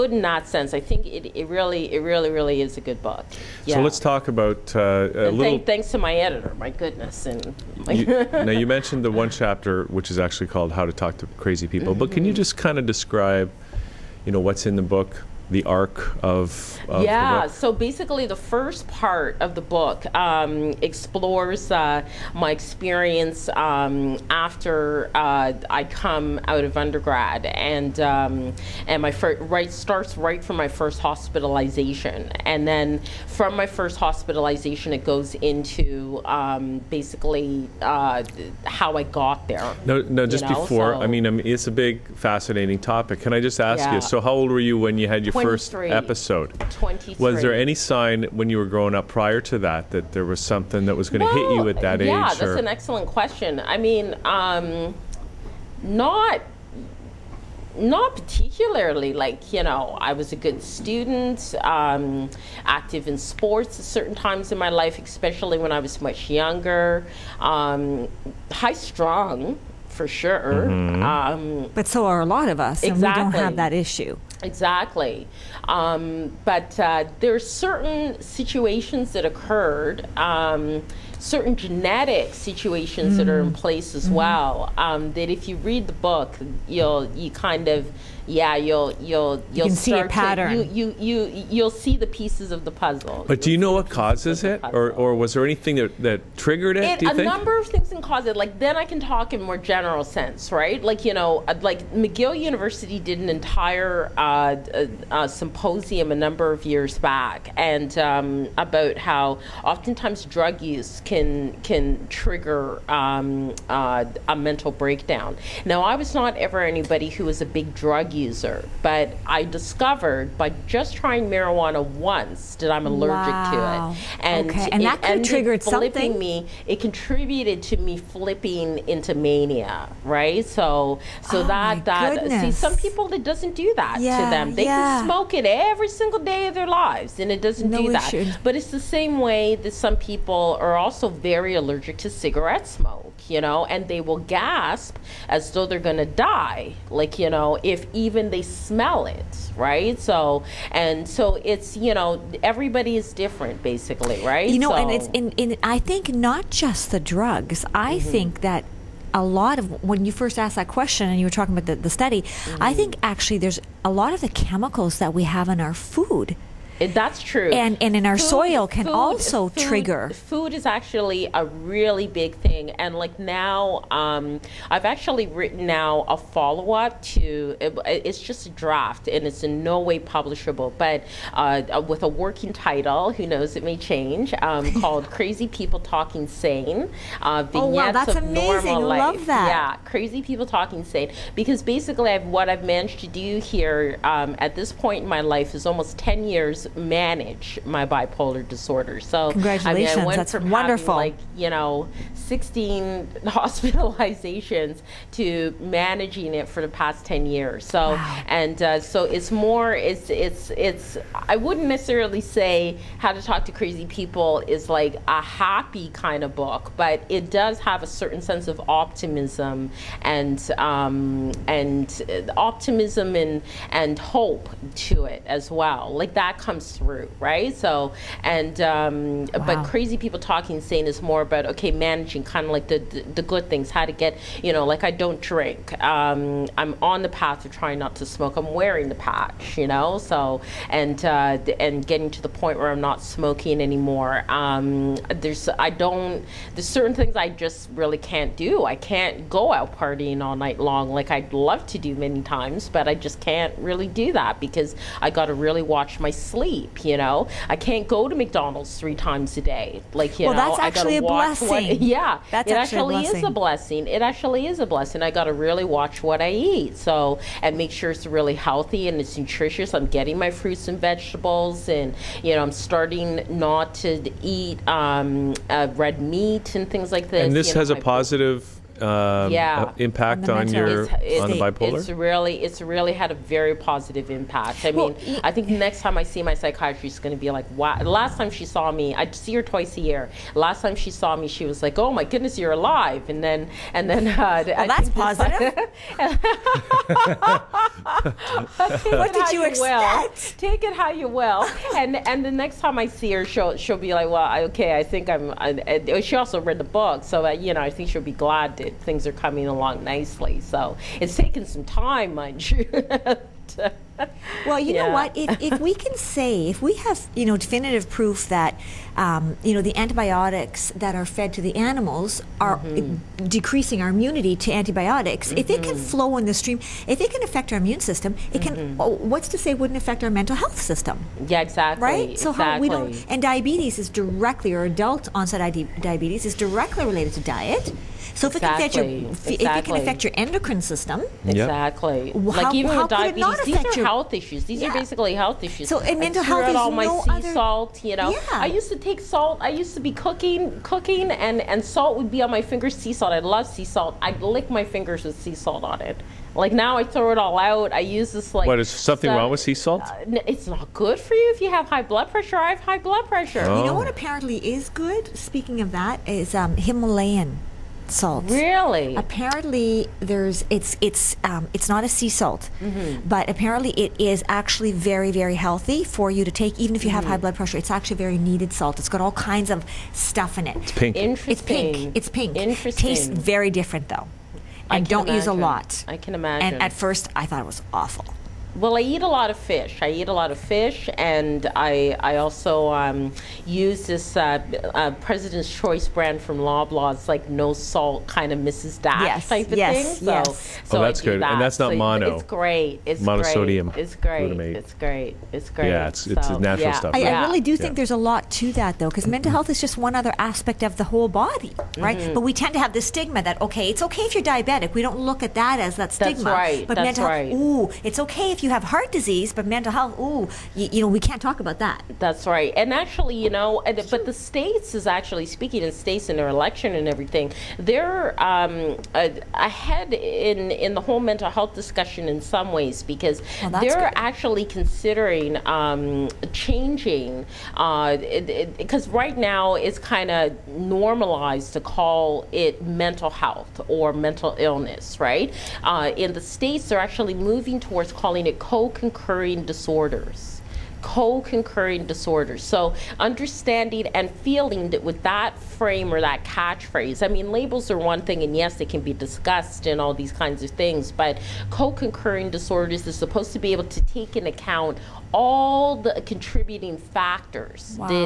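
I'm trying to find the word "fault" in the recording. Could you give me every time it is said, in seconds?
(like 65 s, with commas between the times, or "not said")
not said.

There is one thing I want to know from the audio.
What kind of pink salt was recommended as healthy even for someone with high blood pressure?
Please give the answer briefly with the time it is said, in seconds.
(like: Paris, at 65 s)
Himalayan salt, at 366 s.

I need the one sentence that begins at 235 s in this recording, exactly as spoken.
Um, I'm on the path of trying not to smoke.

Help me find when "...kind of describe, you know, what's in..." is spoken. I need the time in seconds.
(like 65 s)
12 s.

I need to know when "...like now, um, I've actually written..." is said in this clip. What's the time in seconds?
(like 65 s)
172 s.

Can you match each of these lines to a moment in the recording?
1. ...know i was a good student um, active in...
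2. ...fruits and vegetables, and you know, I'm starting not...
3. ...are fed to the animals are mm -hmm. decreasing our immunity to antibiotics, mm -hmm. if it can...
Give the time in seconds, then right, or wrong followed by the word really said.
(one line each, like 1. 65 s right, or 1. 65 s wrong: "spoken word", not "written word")
1. 59 s right
2. 270 s right
3. 320 s right.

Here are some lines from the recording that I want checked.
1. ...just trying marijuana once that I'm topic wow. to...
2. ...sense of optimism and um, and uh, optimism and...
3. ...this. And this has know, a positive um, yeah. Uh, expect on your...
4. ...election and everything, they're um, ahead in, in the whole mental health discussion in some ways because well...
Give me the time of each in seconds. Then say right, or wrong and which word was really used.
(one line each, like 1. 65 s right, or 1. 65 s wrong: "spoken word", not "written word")
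1. 120 s wrong: "allergic", not "topic"
2. 218 s right
3. 277 s wrong: "impact", not "expect"
4. 426 s right.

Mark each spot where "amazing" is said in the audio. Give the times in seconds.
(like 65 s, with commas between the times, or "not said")
188 s.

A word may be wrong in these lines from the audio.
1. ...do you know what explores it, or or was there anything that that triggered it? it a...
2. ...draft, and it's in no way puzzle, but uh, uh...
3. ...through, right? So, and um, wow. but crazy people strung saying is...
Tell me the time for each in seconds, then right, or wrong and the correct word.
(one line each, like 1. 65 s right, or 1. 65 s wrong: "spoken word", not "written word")
1. 93 s wrong: "causes", not "explores"
2. 178 s wrong: "publishable", not "puzzle"
3. 226 s wrong: "talking", not "strung".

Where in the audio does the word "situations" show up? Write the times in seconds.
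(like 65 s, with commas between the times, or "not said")
78 s, 82 s.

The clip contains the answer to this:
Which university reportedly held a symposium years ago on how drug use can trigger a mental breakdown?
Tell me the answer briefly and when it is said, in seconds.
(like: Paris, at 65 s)
McGill University, at 101 s.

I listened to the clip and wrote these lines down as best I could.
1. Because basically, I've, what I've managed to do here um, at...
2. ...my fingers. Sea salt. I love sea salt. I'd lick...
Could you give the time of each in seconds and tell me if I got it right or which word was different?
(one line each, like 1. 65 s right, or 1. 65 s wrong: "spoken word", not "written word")
1. 191 s right
2. 352 s right.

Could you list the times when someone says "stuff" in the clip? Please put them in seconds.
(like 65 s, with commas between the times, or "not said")
359 s, 379 s, 406 s.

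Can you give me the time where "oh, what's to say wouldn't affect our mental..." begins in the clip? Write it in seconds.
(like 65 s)
328 s.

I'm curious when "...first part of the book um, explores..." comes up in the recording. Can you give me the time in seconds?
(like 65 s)
18 s.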